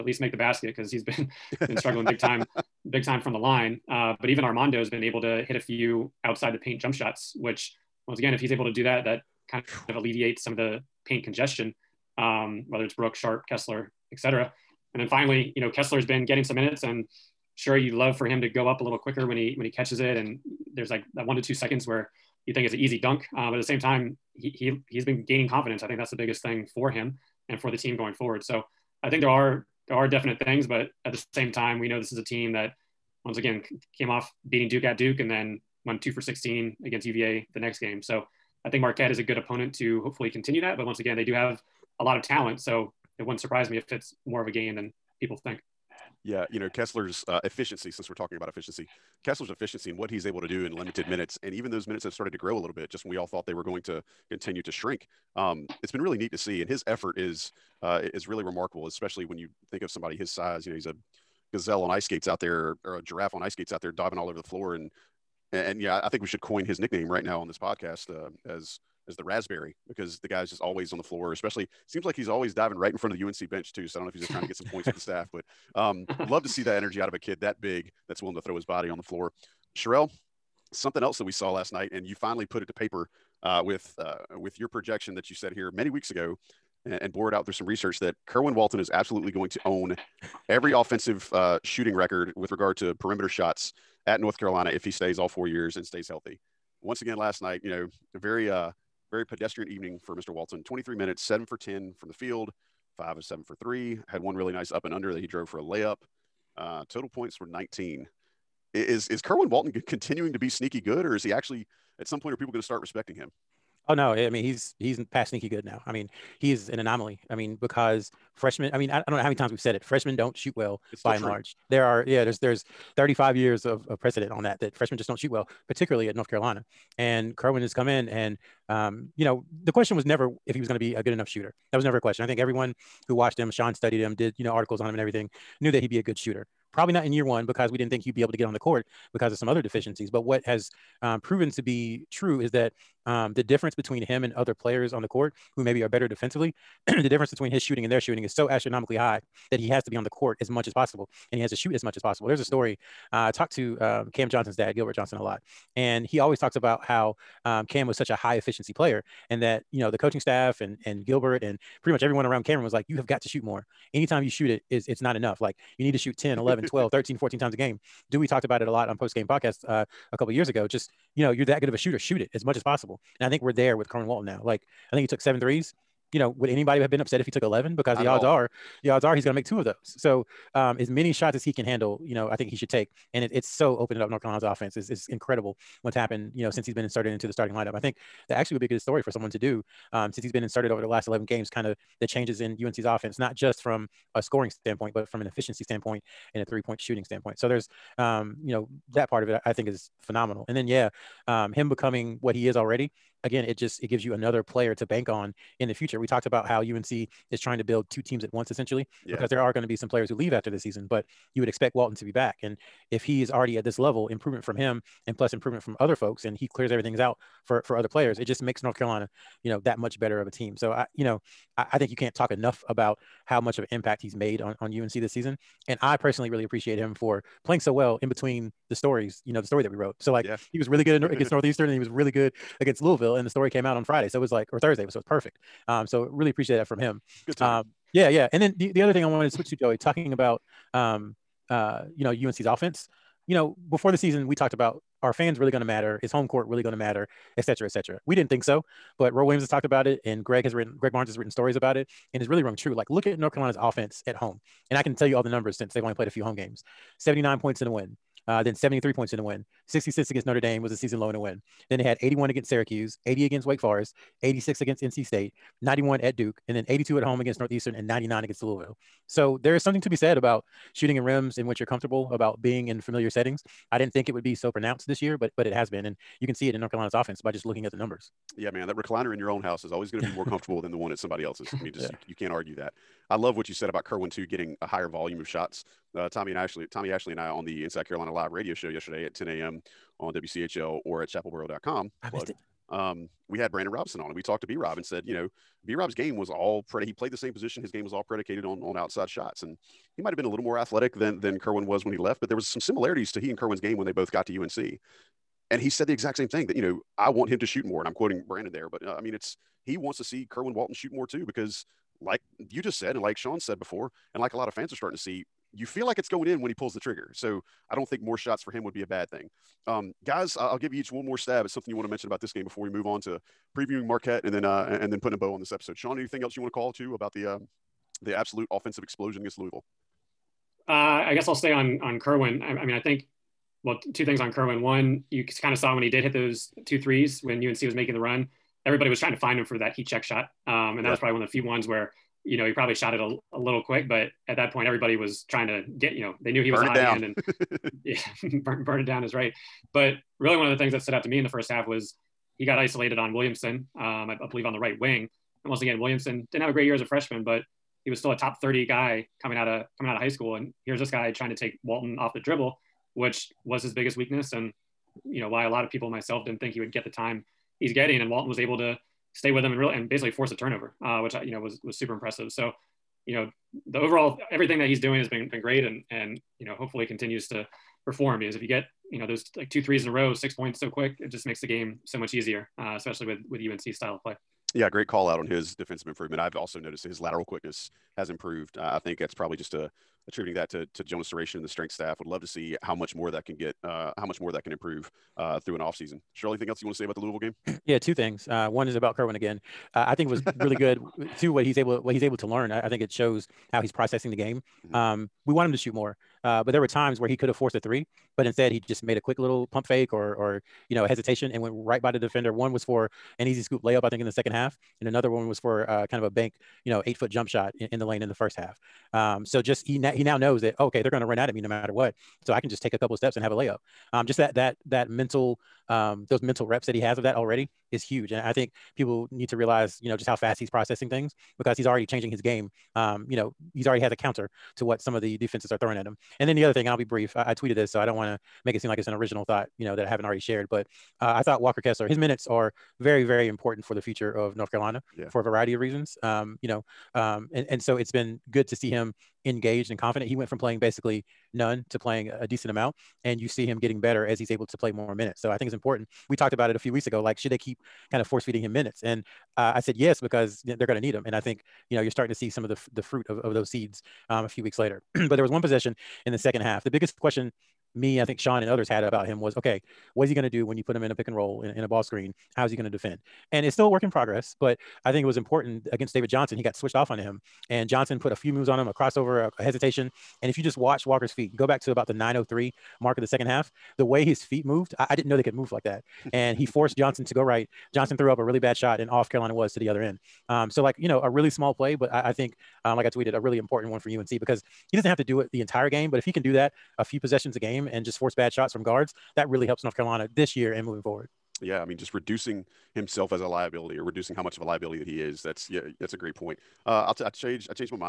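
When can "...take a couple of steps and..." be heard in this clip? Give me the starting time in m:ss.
7:02.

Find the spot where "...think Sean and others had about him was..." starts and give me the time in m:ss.
7:48.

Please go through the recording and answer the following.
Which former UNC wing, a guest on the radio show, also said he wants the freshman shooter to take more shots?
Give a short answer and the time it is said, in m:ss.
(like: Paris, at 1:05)
Brandon Robinson, at 4:53.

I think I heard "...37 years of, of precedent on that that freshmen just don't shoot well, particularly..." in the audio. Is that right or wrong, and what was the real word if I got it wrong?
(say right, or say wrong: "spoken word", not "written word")
wrong: "35", not "37".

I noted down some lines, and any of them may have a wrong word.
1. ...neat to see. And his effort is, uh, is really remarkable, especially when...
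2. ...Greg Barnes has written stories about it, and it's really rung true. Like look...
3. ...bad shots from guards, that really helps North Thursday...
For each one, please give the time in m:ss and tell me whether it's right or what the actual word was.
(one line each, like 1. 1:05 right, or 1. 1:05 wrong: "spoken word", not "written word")
1. 0:56 right
2. 4:10 right
3. 8:18 wrong: "Carolina", not "Thursday".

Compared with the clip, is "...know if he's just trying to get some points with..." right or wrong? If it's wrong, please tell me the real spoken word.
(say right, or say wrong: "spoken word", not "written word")
right.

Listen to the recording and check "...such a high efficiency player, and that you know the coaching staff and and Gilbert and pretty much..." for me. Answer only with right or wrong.
right.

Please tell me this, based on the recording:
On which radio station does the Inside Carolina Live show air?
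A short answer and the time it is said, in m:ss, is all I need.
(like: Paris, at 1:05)
WCHL, at 4:50.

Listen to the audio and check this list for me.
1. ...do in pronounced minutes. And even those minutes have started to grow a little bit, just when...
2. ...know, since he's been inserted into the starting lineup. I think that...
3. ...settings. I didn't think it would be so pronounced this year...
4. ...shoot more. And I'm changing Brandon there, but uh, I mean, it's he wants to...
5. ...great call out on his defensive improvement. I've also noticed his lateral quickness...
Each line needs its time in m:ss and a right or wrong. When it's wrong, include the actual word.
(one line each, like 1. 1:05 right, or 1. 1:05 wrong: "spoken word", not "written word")
1. 0:50 wrong: "limited", not "pronounced"
2. 3:06 right
3. 4:33 right
4. 5:07 wrong: "quoting", not "changing"
5. 6:24 right.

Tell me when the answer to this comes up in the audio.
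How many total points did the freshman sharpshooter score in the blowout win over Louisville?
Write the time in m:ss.
1:47.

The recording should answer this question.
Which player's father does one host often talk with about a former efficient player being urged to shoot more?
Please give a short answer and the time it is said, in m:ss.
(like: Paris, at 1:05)
Gilbert Johnson, at 2:34.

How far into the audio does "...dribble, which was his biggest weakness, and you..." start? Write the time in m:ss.
6:02.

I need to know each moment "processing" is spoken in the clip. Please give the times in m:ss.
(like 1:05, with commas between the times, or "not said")
6:43, 7:10.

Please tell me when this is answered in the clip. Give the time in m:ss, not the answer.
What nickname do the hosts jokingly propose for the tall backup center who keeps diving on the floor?
1:09.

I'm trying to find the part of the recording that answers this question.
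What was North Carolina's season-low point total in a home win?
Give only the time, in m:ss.
4:19.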